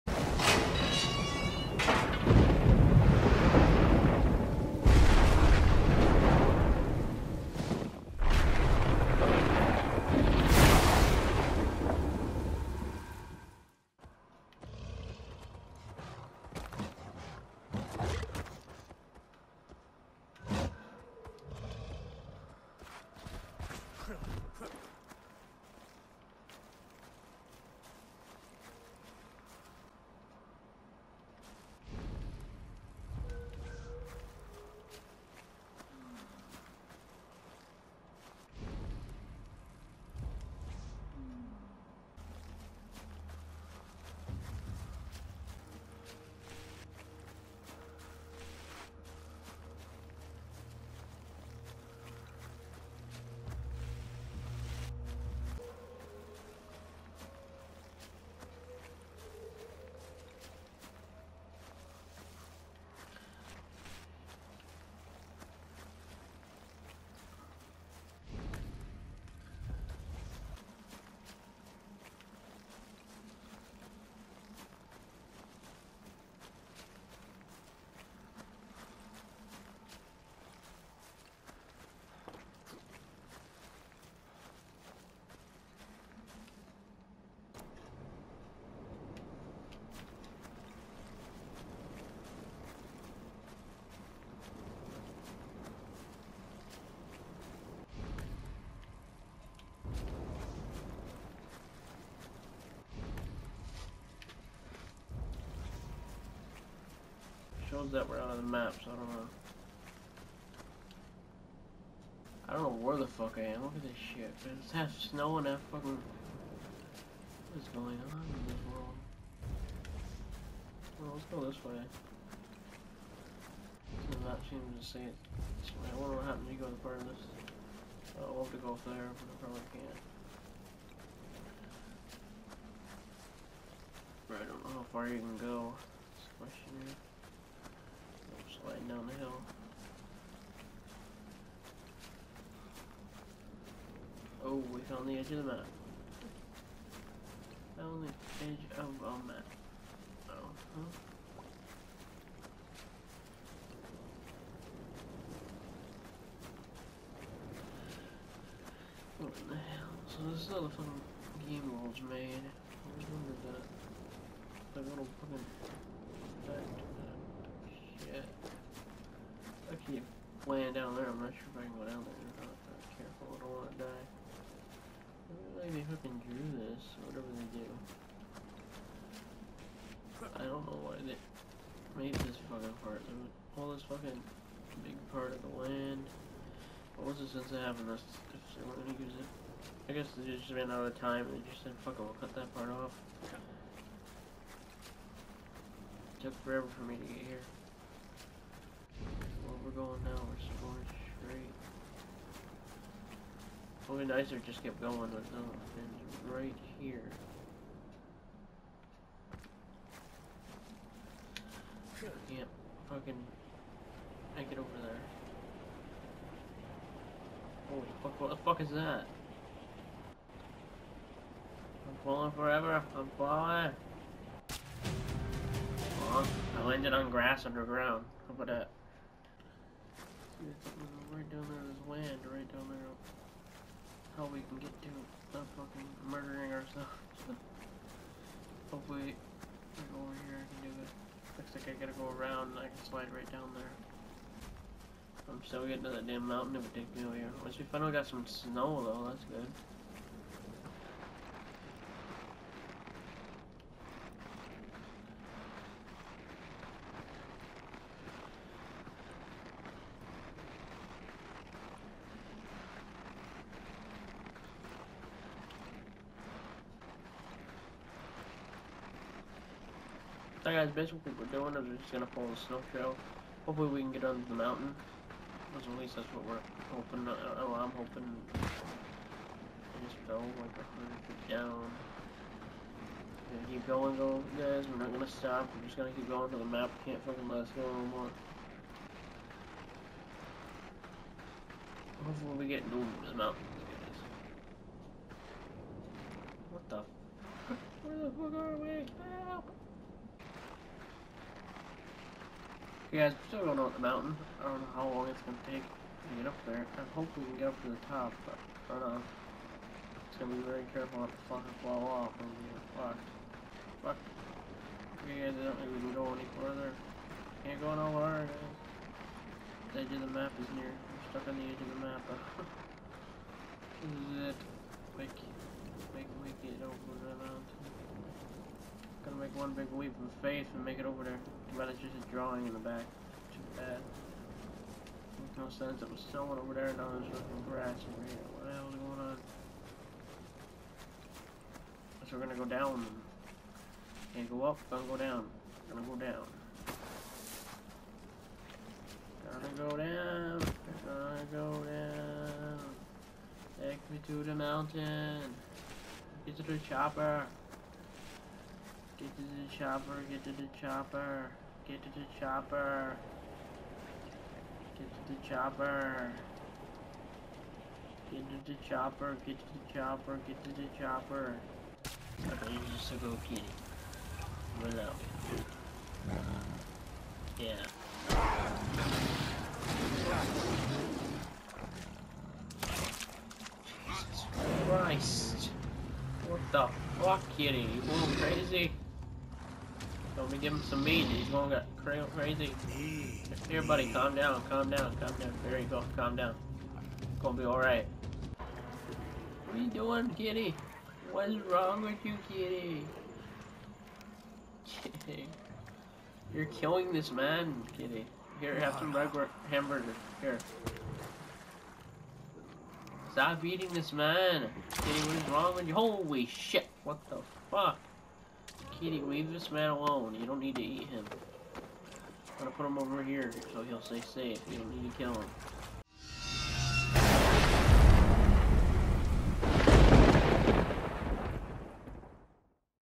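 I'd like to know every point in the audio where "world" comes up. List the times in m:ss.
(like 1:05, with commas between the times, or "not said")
1:58, 2:41.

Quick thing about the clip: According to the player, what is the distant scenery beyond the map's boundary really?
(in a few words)
a drawing.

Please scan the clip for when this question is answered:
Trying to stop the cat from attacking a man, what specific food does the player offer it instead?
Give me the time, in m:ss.
6:48.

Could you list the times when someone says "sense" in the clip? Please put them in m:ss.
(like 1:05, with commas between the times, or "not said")
3:07, 5:35.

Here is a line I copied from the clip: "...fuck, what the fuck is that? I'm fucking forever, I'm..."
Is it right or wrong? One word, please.
wrong.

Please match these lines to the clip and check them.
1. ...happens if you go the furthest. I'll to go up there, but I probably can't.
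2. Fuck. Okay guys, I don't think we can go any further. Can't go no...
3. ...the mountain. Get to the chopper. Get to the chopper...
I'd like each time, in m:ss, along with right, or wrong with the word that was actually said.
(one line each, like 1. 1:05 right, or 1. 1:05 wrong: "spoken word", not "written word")
1. 2:06 right
2. 5:13 right
3. 5:54 right.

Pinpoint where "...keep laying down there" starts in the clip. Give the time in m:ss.
2:49.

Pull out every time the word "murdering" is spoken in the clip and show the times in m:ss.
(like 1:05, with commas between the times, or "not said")
3:56.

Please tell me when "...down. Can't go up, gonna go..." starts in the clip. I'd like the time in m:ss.
5:42.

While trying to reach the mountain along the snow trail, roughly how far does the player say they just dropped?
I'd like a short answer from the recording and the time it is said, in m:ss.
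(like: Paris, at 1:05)
100 feet, at 4:40.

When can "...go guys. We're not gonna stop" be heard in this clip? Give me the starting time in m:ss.
4:43.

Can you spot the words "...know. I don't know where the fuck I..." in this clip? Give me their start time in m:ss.
1:49.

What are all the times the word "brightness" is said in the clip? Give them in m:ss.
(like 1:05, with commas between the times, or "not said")
not said.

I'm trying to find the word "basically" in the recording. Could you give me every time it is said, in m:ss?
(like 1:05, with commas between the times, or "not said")
4:30.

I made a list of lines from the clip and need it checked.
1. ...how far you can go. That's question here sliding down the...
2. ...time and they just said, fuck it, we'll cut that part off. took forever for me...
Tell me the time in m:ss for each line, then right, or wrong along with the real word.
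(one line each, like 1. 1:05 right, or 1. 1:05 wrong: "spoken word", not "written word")
1. 2:14 right
2. 3:10 right.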